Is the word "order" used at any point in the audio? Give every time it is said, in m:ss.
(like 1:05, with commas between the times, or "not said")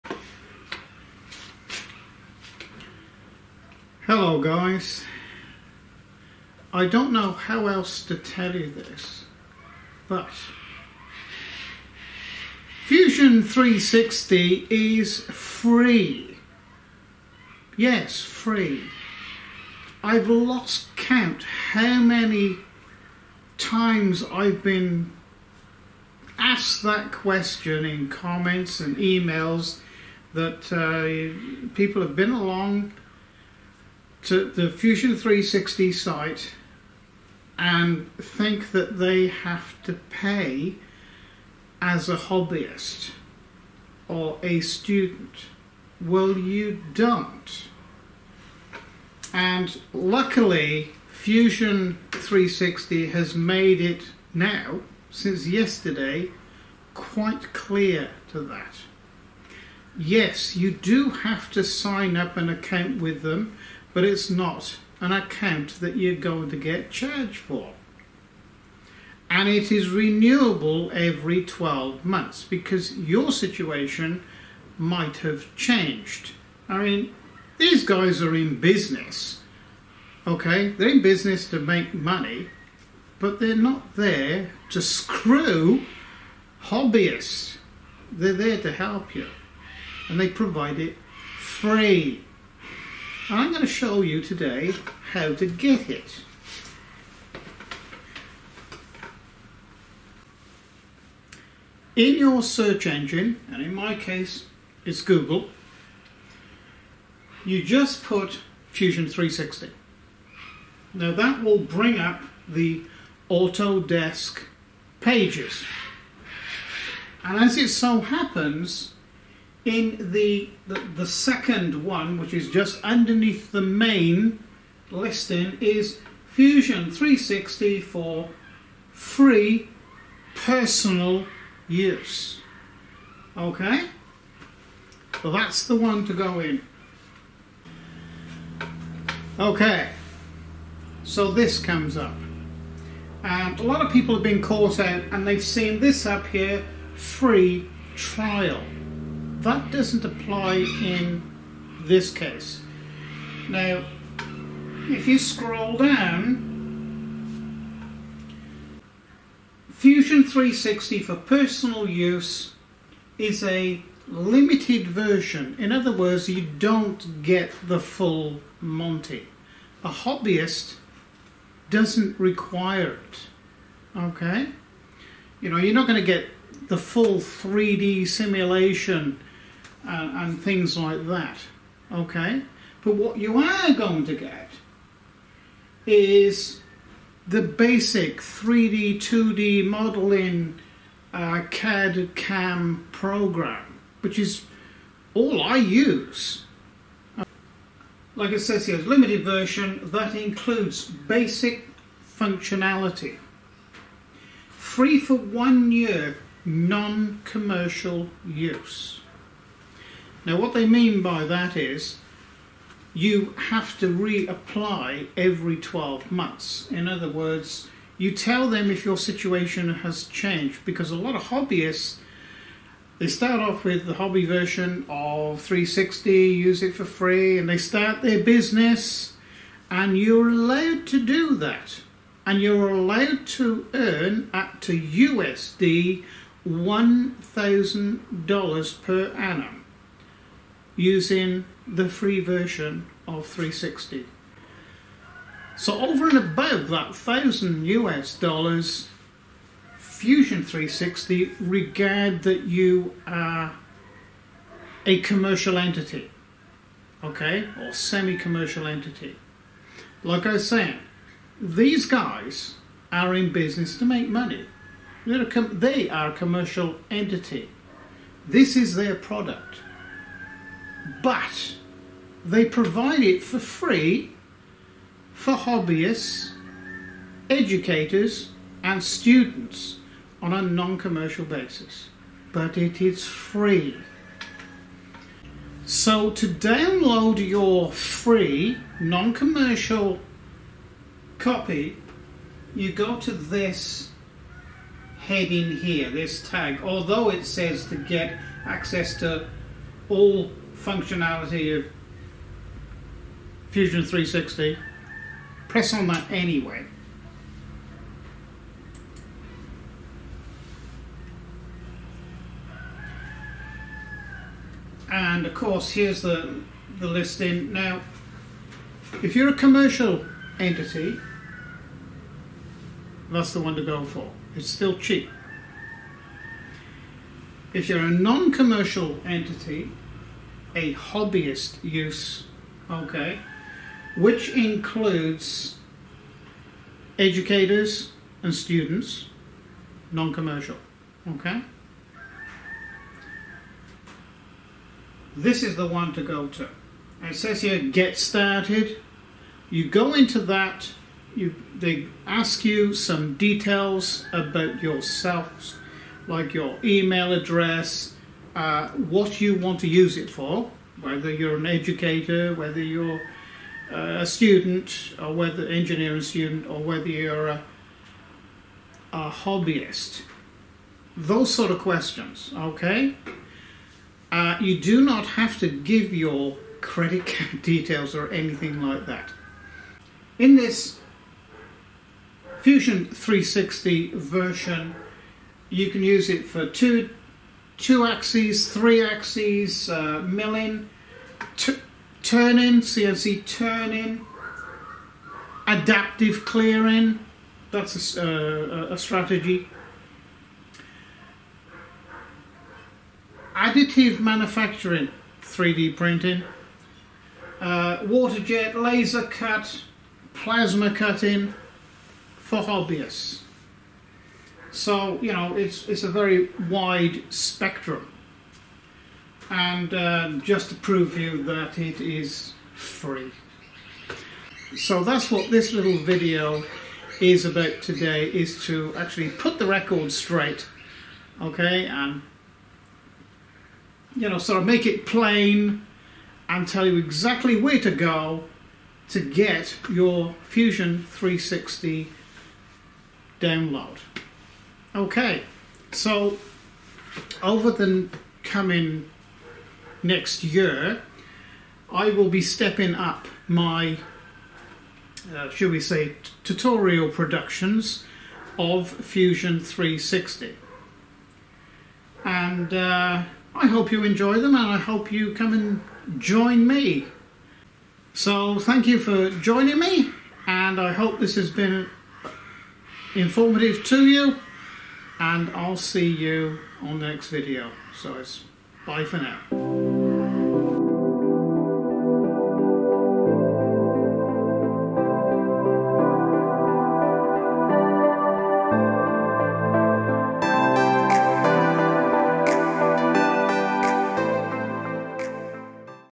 not said.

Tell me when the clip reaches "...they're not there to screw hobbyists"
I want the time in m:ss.
1:23.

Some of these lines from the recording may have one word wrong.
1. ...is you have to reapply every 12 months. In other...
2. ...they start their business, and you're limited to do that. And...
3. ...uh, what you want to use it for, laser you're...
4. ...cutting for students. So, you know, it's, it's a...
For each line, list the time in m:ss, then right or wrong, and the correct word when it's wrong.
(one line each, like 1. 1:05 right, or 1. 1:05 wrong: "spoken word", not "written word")
1. 3:31 right
2. 3:47 wrong: "allowed", not "limited"
3. 5:58 wrong: "whether", not "laser"
4. 6:50 wrong: "hobbyists", not "students".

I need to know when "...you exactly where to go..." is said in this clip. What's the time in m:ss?
7:16.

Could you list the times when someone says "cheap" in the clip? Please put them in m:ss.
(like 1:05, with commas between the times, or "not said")
5:24.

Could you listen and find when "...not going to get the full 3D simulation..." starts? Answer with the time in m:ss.
2:55.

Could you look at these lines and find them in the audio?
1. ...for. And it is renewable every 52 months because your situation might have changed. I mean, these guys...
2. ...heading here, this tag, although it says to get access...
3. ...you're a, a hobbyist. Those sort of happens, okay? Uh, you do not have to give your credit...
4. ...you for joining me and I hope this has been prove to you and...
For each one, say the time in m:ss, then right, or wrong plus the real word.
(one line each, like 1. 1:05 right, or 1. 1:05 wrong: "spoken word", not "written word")
1. 1:07 wrong: "12", not "52"
2. 4:54 right
3. 6:06 wrong: "questions", not "happens"
4. 7:48 wrong: "informative", not "prove".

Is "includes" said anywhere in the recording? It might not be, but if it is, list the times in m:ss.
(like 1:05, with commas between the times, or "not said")
3:20, 5:34.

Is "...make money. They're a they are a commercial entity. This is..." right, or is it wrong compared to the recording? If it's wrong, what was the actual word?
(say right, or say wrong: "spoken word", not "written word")
right.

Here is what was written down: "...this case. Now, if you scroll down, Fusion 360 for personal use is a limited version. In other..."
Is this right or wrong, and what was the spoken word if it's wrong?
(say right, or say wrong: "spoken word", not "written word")
right.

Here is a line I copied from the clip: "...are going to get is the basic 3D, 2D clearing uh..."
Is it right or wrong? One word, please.
wrong.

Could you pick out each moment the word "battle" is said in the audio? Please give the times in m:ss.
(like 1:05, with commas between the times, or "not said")
not said.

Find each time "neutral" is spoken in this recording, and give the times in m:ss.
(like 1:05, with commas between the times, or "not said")
not said.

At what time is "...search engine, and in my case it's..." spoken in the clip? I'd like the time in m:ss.
1:42.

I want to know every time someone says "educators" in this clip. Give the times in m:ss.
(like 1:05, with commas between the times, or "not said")
4:37, 5:36, 6:01.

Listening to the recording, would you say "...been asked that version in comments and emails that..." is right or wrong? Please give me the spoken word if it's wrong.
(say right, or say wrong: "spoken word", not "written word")
wrong: "question", not "version".